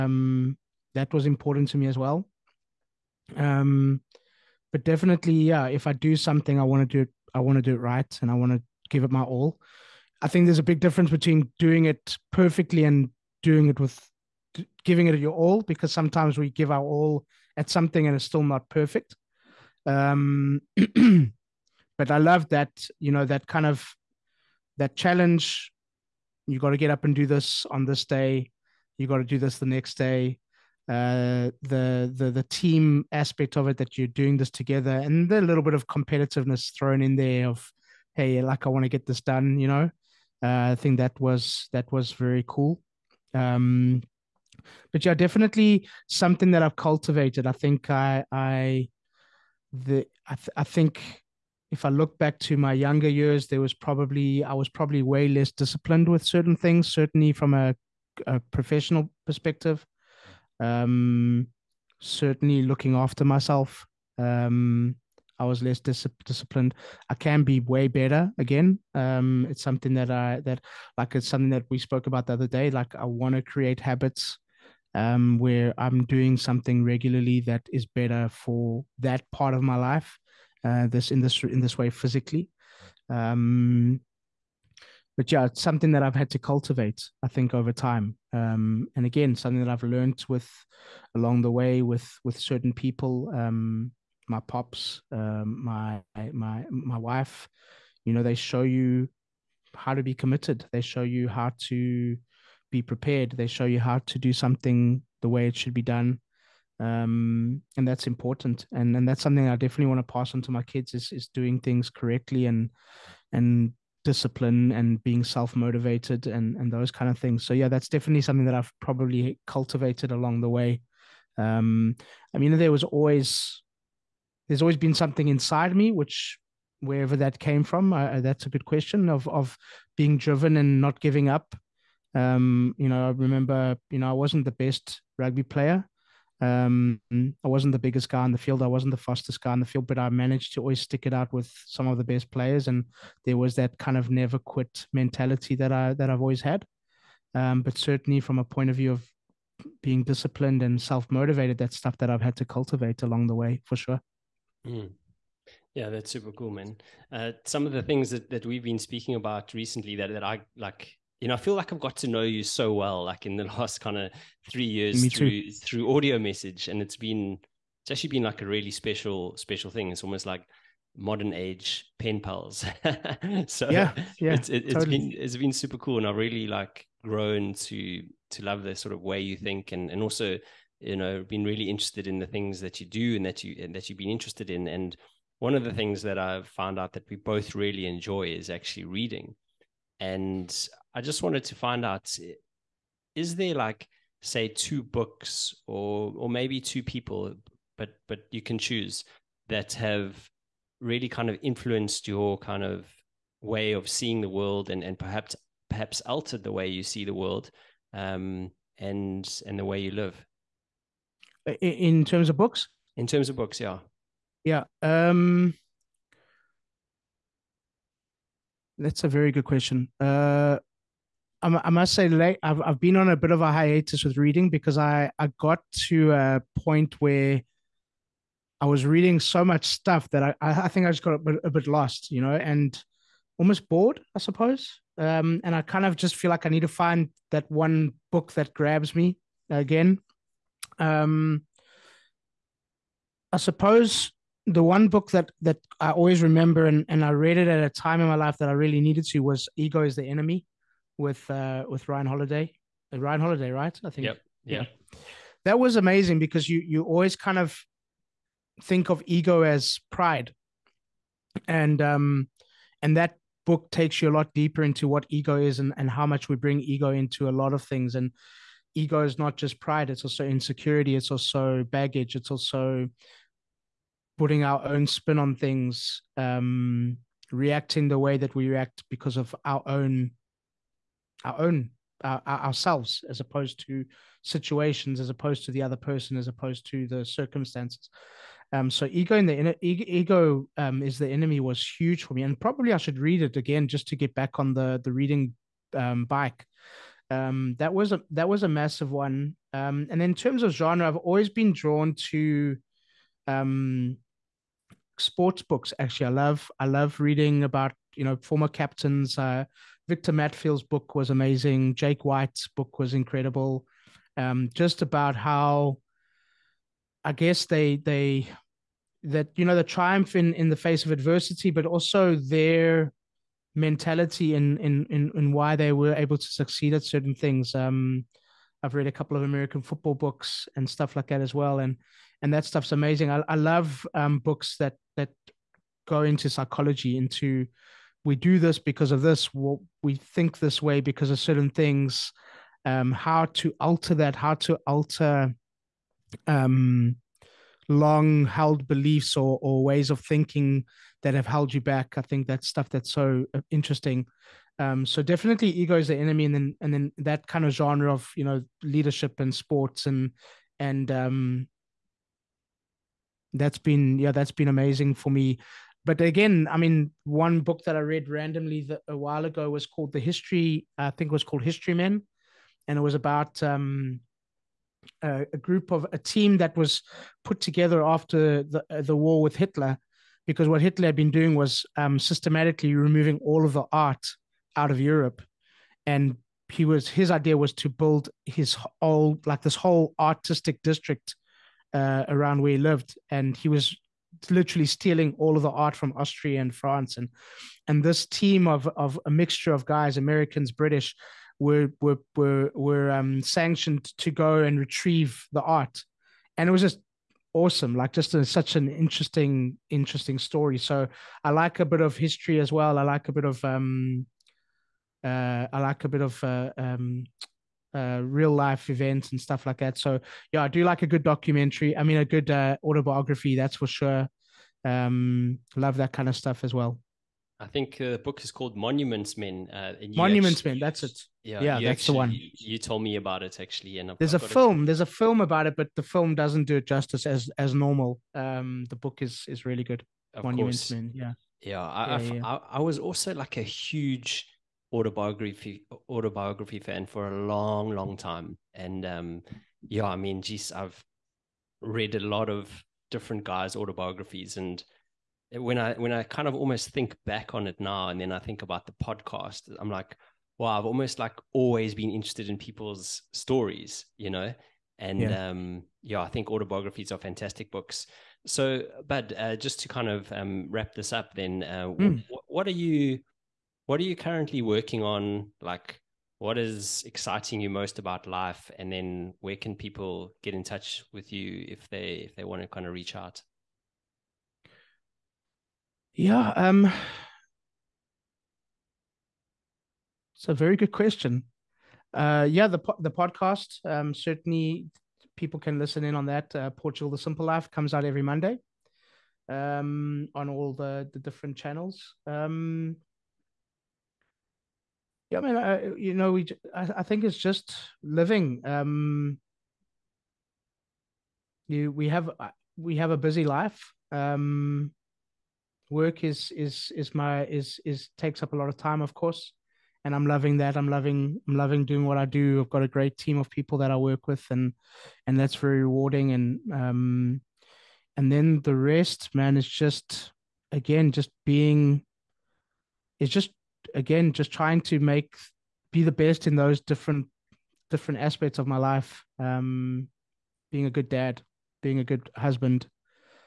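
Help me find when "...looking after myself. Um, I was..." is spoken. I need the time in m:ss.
1:02.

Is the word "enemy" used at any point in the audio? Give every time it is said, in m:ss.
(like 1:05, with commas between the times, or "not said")
4:10, 4:51, 5:55.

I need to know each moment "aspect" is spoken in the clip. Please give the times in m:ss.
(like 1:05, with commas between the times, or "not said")
0:33, 8:58.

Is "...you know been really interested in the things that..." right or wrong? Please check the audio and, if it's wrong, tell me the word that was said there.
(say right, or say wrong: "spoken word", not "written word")
right.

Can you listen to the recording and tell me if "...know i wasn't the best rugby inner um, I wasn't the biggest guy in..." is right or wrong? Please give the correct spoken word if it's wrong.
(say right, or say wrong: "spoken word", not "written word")
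wrong: "player", not "inner".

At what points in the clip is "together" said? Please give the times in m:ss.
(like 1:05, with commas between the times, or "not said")
0:34, 6:17.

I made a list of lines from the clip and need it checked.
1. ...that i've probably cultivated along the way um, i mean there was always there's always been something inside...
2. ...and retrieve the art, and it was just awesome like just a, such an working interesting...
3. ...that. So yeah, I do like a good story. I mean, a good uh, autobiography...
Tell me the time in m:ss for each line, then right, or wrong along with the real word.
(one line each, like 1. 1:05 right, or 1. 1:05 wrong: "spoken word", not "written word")
1. 1:58 right
2. 6:44 wrong: "interesting", not "working"
3. 6:59 wrong: "documentary", not "story".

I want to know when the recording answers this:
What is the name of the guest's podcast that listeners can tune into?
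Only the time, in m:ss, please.
8:16.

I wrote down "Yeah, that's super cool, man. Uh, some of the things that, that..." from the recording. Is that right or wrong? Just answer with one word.
right.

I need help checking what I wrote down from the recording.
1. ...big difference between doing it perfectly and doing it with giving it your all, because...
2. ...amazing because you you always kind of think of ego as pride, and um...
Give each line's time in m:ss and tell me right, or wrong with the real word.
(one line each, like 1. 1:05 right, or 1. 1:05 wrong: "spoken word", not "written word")
1. 0:10 right
2. 4:15 right.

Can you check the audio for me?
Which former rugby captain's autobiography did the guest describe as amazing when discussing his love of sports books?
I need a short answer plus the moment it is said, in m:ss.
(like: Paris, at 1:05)
Victor Matfield, at 5:09.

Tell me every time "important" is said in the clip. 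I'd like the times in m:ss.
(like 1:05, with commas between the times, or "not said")
0:01, 1:48.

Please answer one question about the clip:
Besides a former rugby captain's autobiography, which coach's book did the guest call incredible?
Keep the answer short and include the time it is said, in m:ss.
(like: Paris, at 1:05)
Jake White, at 5:11.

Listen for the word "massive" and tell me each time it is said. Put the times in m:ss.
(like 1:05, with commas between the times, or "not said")
4:58.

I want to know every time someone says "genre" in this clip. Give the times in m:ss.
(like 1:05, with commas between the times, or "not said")
5:00, 5:57.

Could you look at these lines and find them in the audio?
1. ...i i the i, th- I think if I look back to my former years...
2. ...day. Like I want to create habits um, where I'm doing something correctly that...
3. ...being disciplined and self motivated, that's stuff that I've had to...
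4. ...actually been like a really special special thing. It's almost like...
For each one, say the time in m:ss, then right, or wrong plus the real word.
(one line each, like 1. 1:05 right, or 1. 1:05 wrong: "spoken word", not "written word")
1. 0:47 wrong: "younger", not "former"
2. 1:12 wrong: "regularly", not "correctly"
3. 2:29 right
4. 2:47 right.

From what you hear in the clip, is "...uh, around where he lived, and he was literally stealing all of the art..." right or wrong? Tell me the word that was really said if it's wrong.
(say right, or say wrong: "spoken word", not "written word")
right.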